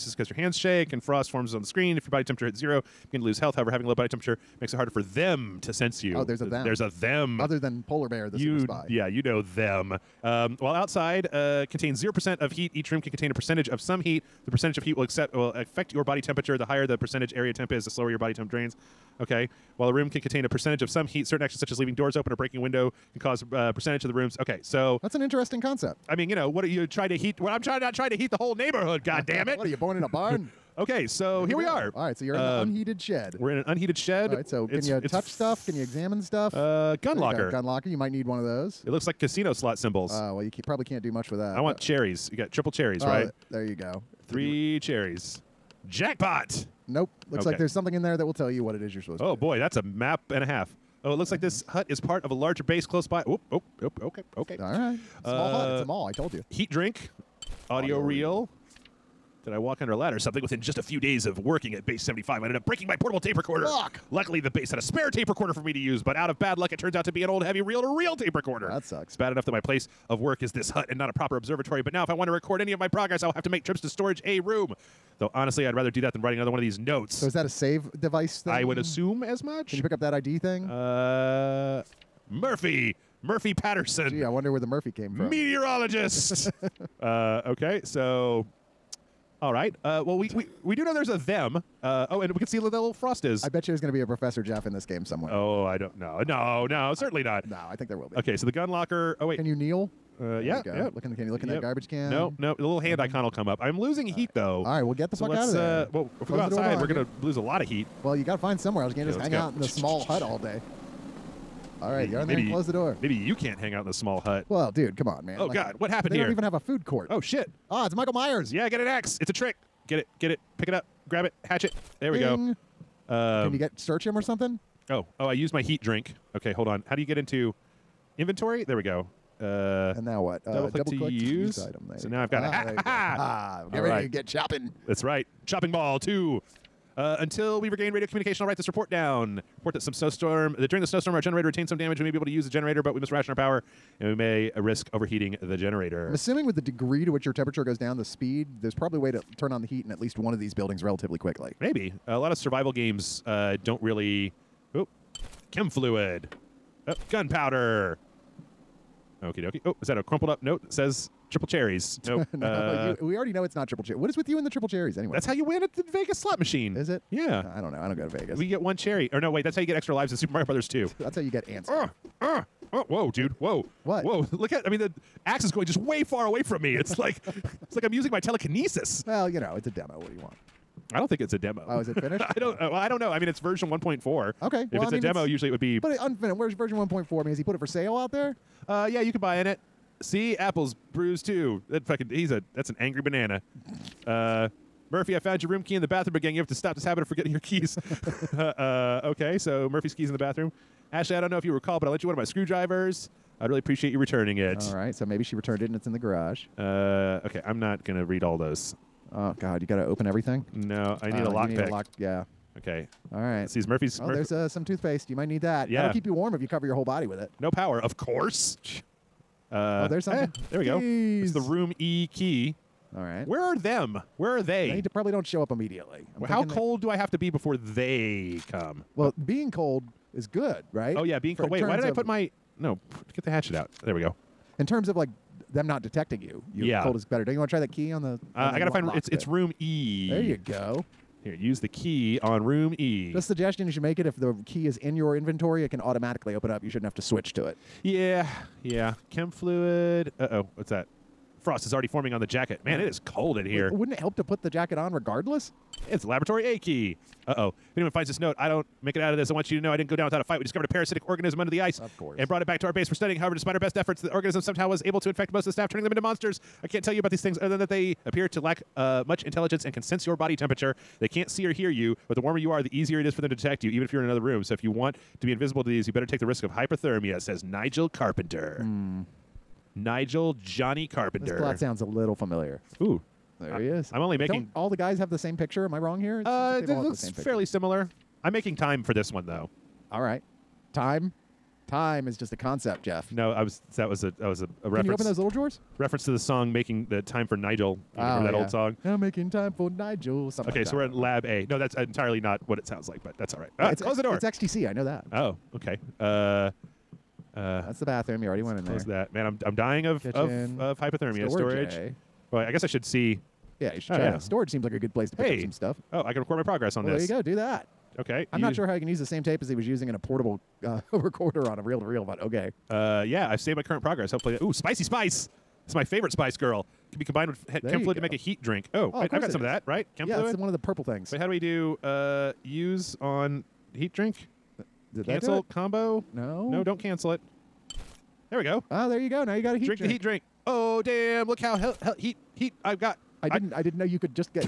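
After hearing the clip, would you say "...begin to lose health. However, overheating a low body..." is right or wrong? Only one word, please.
wrong.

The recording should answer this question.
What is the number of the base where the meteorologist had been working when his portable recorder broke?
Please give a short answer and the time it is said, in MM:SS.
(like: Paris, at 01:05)
75, at 01:01.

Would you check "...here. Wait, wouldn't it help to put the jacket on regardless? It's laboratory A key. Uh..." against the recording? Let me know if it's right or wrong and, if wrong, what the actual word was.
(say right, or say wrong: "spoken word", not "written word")
right.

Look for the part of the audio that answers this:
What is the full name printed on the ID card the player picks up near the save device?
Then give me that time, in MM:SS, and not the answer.
01:23.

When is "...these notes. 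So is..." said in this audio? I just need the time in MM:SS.
01:16.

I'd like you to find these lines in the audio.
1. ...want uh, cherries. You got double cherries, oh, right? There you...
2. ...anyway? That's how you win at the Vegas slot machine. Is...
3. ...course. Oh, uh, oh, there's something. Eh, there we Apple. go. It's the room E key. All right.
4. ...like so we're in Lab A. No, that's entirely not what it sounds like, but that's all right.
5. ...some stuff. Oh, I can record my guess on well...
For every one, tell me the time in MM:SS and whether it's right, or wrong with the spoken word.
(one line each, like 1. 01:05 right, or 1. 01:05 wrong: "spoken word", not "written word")
1. 00:41 wrong: "triple", not "double"
2. 02:44 right
3. 03:37 wrong: "Keys", not "Apple"
4. 05:00 right
5. 05:15 wrong: "progress", not "guess".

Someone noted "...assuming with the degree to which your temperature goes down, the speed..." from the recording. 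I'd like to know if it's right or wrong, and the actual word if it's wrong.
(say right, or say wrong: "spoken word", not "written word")
right.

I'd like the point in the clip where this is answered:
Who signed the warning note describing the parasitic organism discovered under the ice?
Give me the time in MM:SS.
04:37.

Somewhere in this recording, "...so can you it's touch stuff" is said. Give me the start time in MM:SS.
00:34.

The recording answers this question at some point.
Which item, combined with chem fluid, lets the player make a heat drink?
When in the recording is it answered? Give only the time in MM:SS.
05:24.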